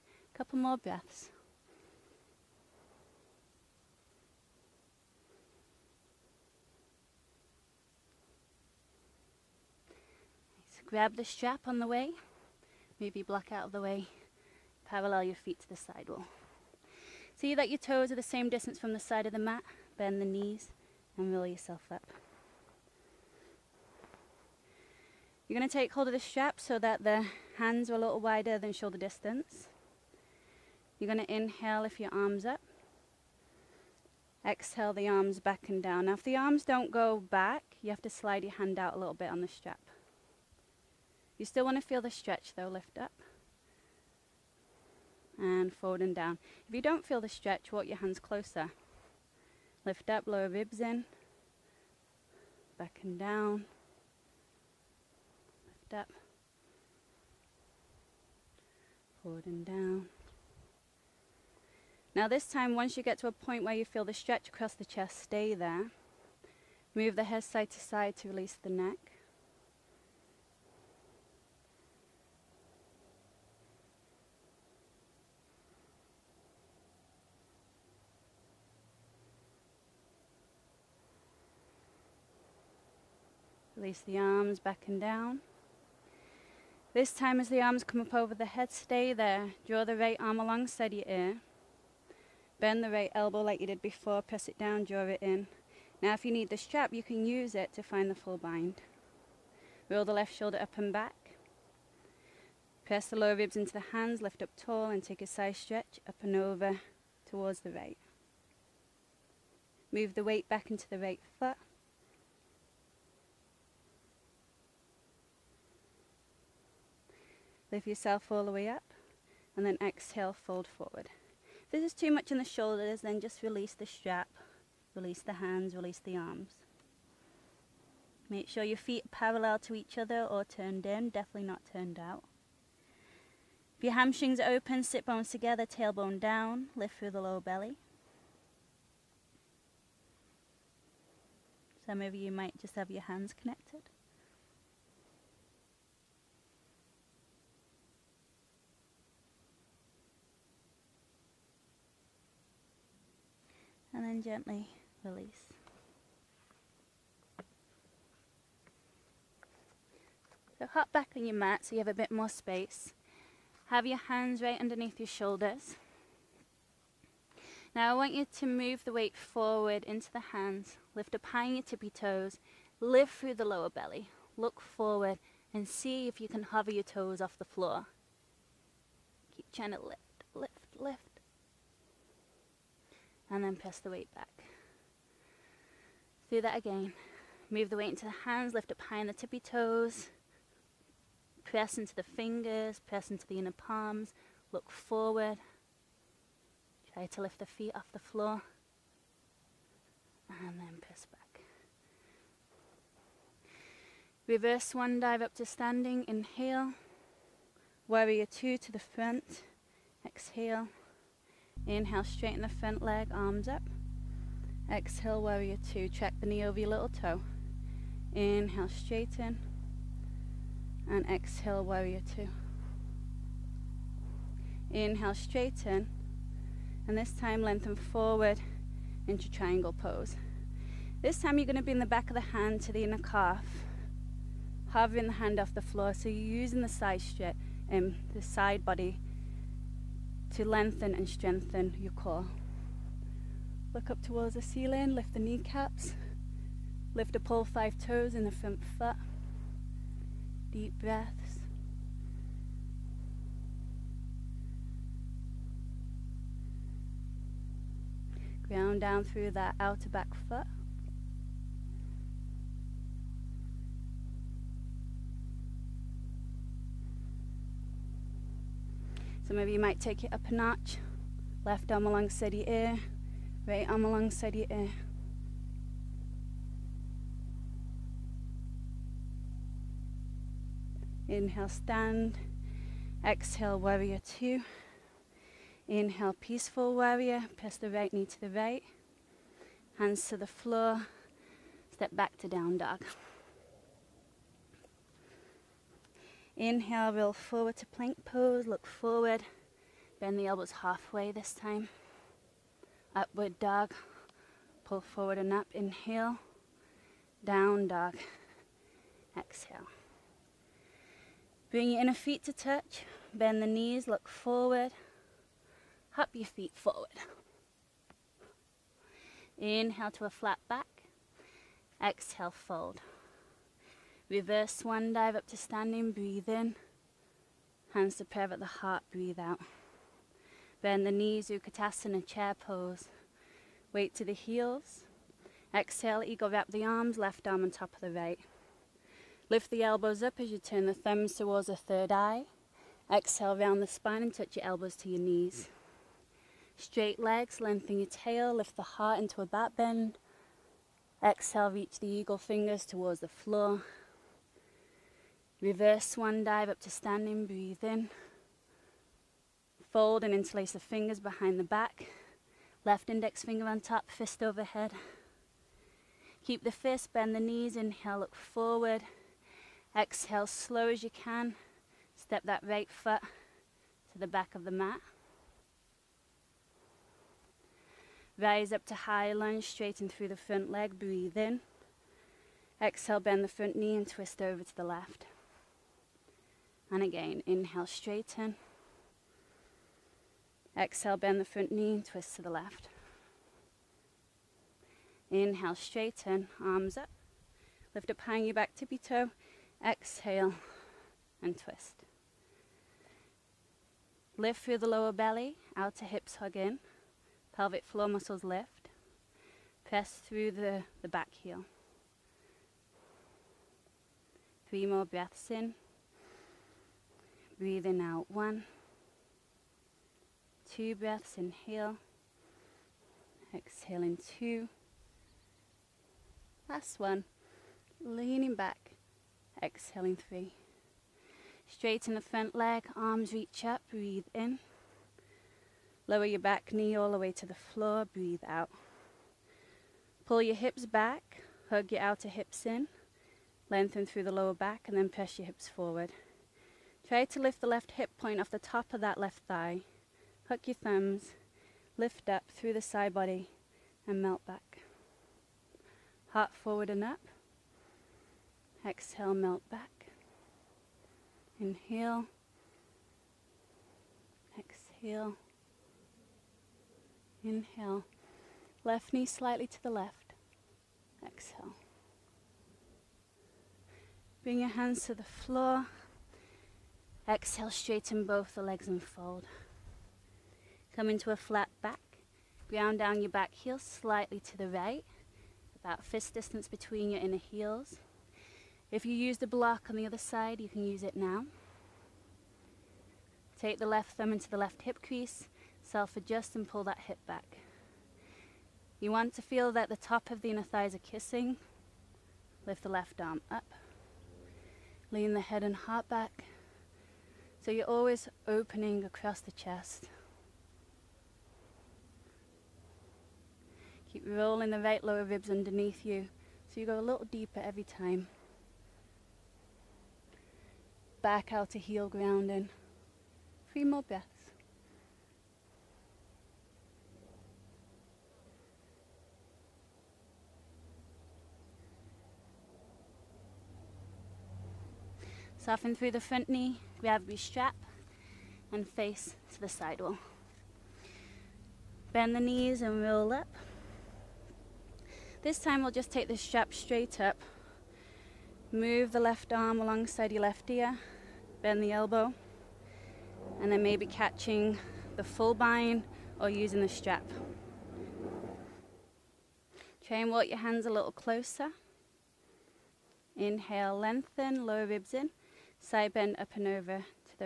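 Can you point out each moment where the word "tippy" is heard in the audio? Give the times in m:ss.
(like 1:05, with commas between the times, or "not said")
2:51, 3:09, 6:38.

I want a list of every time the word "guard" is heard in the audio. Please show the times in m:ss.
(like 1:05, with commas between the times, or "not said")
not said.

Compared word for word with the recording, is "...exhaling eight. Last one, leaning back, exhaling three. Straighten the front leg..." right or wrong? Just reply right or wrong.
wrong.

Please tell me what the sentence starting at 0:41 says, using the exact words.
You still want to feel the stretch though, lift up and forward and down.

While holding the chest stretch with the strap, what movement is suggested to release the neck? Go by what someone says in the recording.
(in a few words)
Move the head side to side.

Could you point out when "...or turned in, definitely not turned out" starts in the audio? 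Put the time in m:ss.
2:10.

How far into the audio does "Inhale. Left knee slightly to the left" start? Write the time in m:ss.
7:47.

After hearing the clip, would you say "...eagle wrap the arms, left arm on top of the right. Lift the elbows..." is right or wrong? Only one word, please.
right.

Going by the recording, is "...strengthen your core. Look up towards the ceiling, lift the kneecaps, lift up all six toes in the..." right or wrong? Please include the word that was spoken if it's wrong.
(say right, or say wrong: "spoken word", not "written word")
wrong: "five", not "six".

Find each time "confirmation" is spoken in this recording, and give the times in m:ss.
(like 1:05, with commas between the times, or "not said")
not said.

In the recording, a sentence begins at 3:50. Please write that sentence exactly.
This time, you're going to in the back of the hand to the inner calf, hovering the hand off the floor.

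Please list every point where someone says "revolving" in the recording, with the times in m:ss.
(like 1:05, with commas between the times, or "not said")
not said.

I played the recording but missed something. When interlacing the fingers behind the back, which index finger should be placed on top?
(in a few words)
Left index finger.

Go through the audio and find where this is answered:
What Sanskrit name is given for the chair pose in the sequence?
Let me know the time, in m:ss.
5:31.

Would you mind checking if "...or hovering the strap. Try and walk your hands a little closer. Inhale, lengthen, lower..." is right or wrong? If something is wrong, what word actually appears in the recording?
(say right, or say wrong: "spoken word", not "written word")
wrong: "using", not "hovering".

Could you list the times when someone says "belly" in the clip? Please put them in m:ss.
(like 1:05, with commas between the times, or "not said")
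2:17, 2:53, 6:44.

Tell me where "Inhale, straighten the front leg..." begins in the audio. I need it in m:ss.
3:31.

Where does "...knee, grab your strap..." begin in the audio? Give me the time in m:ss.
8:56.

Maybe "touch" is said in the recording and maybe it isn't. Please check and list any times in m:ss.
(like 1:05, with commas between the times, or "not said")
5:12, 5:44.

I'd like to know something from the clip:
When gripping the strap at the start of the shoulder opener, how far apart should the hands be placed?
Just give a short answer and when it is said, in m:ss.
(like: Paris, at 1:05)
A little wider than shoulder distance, at 0:27.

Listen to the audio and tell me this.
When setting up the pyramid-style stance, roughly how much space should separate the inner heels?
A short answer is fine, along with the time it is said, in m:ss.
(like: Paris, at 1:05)
About fist distance, at 8:05.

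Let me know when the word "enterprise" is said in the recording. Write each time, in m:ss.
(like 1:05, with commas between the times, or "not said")
not said.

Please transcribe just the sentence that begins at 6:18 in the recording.
Rise up to high lunge, straighten through the front leg, breathe in.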